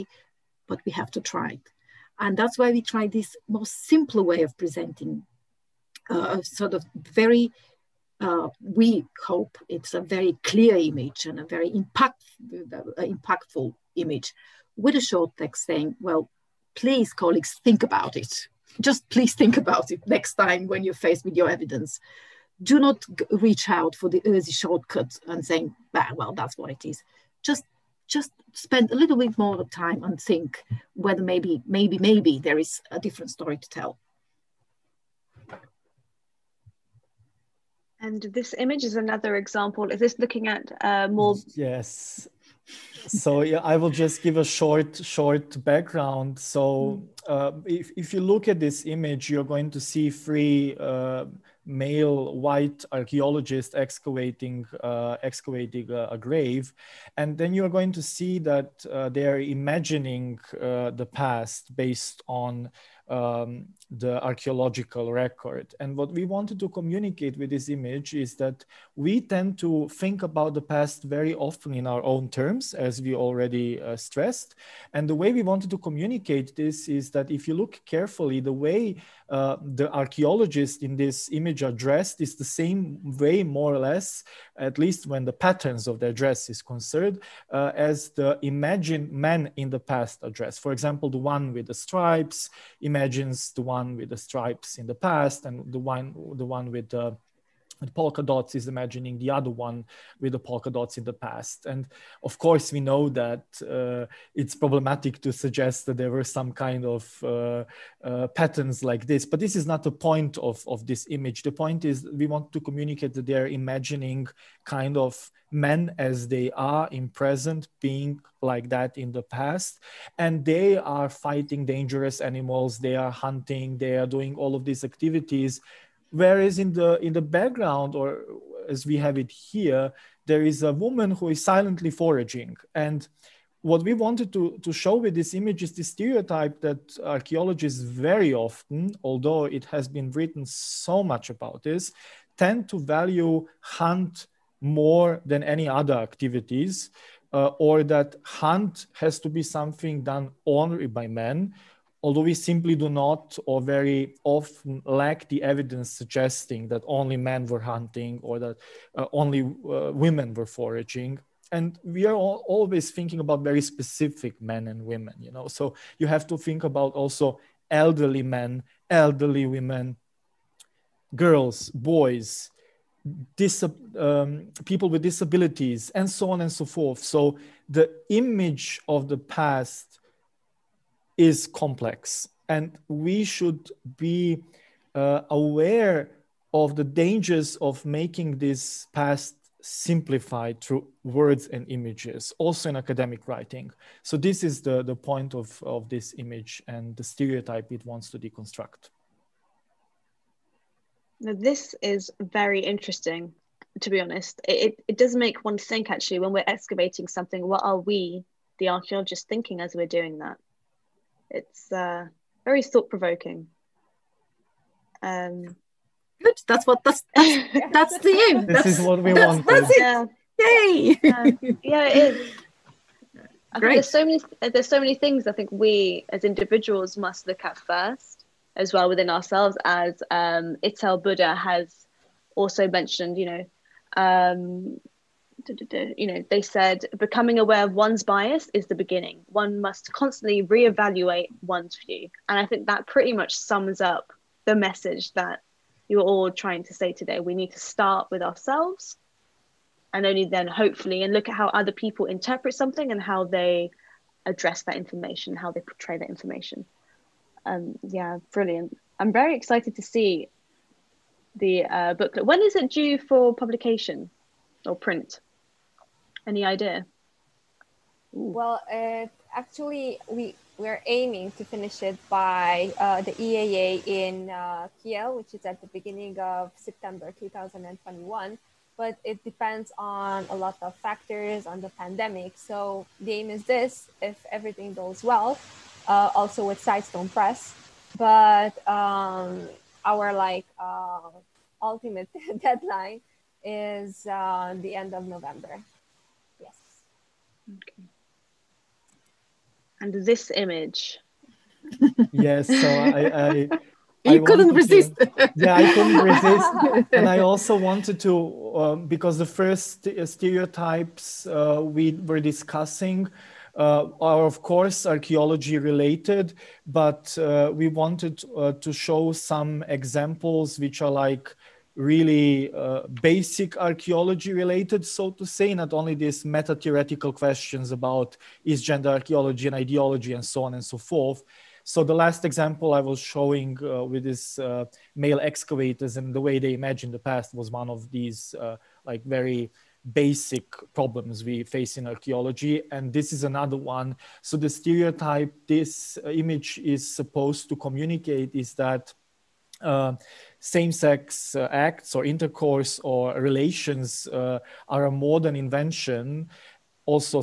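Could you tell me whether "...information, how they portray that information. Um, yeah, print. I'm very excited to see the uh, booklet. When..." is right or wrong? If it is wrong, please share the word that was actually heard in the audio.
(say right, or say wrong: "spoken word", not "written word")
wrong: "brilliant", not "print".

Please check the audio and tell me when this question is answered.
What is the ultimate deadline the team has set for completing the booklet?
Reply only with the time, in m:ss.
4:54.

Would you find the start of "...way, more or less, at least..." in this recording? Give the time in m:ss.
1:23.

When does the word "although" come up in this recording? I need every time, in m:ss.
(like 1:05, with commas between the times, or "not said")
2:19, 2:32.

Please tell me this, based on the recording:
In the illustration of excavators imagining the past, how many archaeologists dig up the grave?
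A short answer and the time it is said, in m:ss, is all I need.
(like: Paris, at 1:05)
3, at 0:50.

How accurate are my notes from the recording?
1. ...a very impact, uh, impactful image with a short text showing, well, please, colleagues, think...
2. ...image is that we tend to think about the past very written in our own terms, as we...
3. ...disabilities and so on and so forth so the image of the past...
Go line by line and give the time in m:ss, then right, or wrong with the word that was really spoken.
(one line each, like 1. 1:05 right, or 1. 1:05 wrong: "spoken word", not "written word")
1. 0:11 wrong: "saying", not "showing"
2. 1:07 wrong: "often", not "written"
3. 2:55 right.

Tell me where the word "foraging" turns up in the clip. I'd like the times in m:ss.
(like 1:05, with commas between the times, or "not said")
2:11, 2:40.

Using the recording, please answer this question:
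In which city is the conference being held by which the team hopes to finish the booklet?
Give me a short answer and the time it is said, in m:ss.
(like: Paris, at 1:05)
Kiel, at 4:34.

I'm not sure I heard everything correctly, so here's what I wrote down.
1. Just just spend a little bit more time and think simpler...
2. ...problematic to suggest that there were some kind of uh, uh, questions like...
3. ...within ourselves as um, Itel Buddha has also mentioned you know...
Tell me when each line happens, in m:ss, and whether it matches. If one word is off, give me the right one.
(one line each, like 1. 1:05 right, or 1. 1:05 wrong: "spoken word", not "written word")
1. 0:27 wrong: "whether", not "simpler"
2. 1:44 wrong: "patterns", not "questions"
3. 3:48 right.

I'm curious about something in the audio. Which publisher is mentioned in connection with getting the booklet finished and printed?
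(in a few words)
Sidestone Press.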